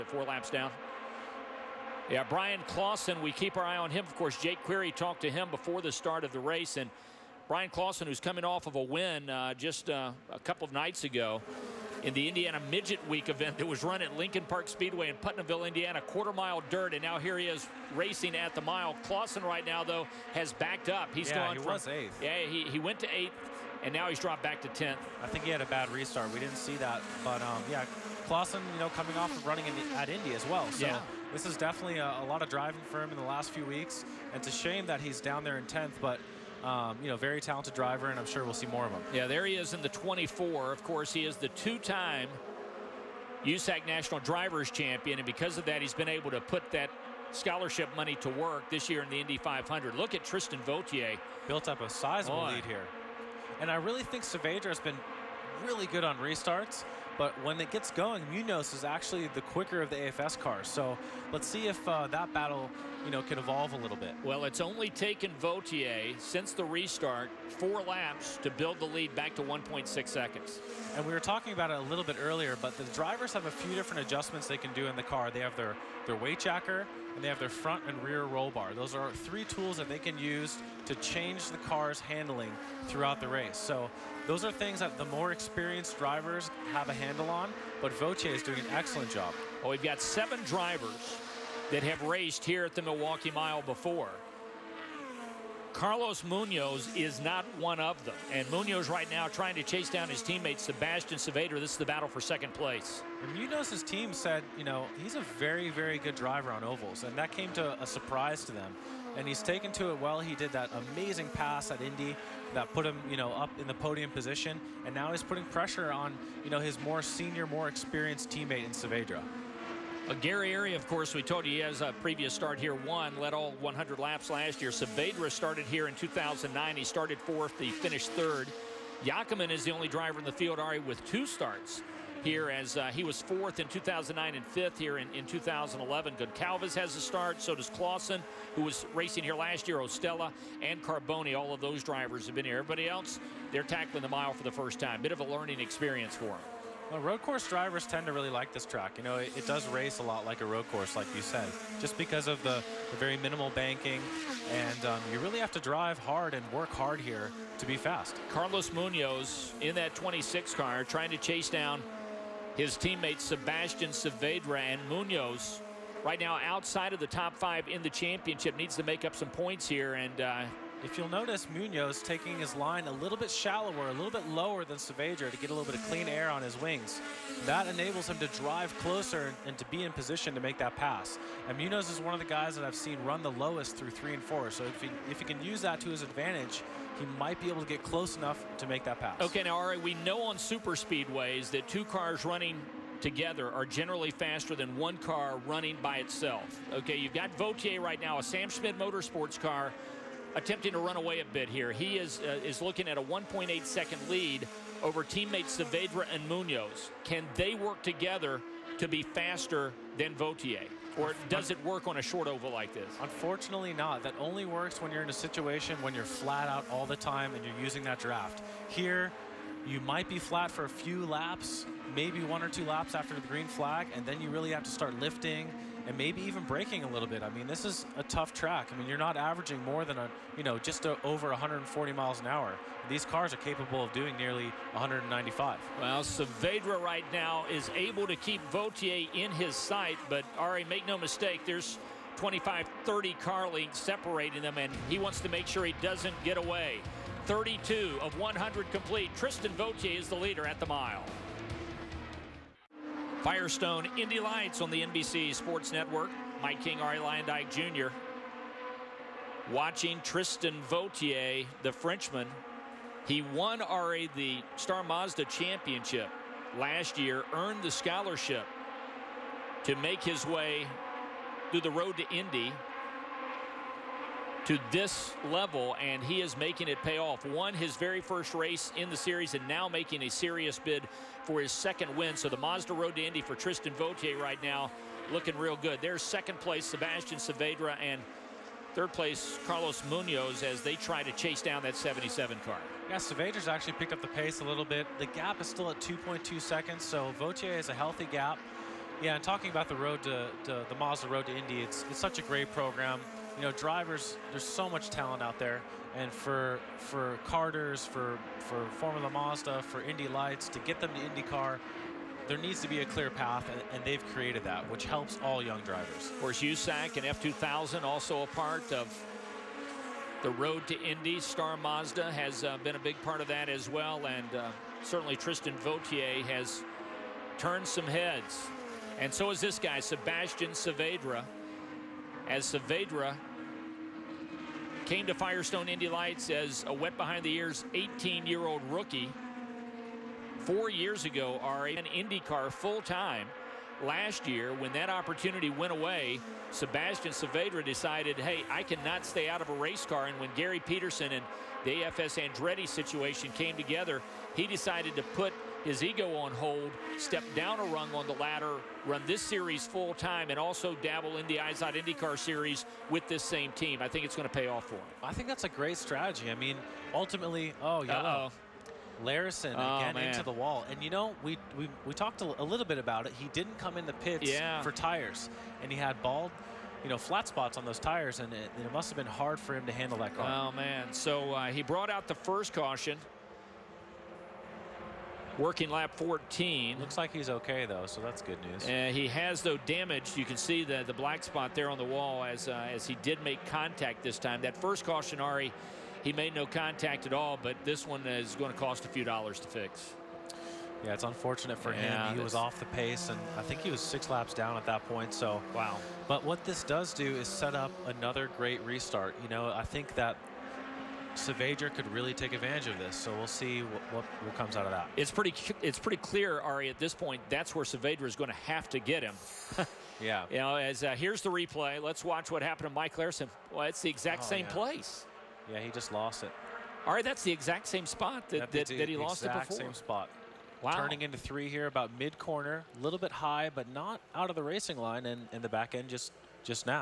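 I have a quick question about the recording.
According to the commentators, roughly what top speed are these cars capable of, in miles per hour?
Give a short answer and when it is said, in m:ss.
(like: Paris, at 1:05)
195, at 3:54.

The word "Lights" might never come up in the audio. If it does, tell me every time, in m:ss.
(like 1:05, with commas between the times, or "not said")
4:14, 5:10, 5:35.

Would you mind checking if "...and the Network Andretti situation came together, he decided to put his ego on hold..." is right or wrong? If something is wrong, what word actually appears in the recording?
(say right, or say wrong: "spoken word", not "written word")
wrong: "AFS", not "Network".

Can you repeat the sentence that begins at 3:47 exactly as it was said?
I mean, this is a tough track.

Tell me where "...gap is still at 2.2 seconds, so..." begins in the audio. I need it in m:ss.
4:55.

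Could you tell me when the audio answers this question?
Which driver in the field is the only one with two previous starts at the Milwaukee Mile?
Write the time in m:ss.
2:09.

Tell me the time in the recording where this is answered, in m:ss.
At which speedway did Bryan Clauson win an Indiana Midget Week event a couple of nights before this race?
0:14.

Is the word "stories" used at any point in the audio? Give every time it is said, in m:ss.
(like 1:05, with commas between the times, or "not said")
not said.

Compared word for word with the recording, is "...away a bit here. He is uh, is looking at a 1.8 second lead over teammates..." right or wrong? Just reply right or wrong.
right.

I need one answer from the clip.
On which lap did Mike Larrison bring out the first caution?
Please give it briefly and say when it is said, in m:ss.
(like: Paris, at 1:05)
14, at 6:25.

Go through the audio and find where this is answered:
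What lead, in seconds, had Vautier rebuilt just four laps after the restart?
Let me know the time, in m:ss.
1:09.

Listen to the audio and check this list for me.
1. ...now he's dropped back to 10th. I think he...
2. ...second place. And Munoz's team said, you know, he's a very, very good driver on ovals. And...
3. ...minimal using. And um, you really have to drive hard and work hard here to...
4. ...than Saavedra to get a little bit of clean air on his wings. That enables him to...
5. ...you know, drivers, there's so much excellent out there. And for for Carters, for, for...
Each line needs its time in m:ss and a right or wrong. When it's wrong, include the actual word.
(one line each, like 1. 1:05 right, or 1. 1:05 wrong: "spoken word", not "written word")
1. 0:23 right
2. 1:42 right
3. 2:33 wrong: "banking", not "using"
4. 2:54 right
5. 5:03 wrong: "talent", not "excellent".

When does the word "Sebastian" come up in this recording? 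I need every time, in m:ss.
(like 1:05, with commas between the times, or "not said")
1:40, 2:43, 4:46, 5:29, 5:46.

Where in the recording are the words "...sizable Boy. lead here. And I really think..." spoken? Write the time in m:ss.
0:51.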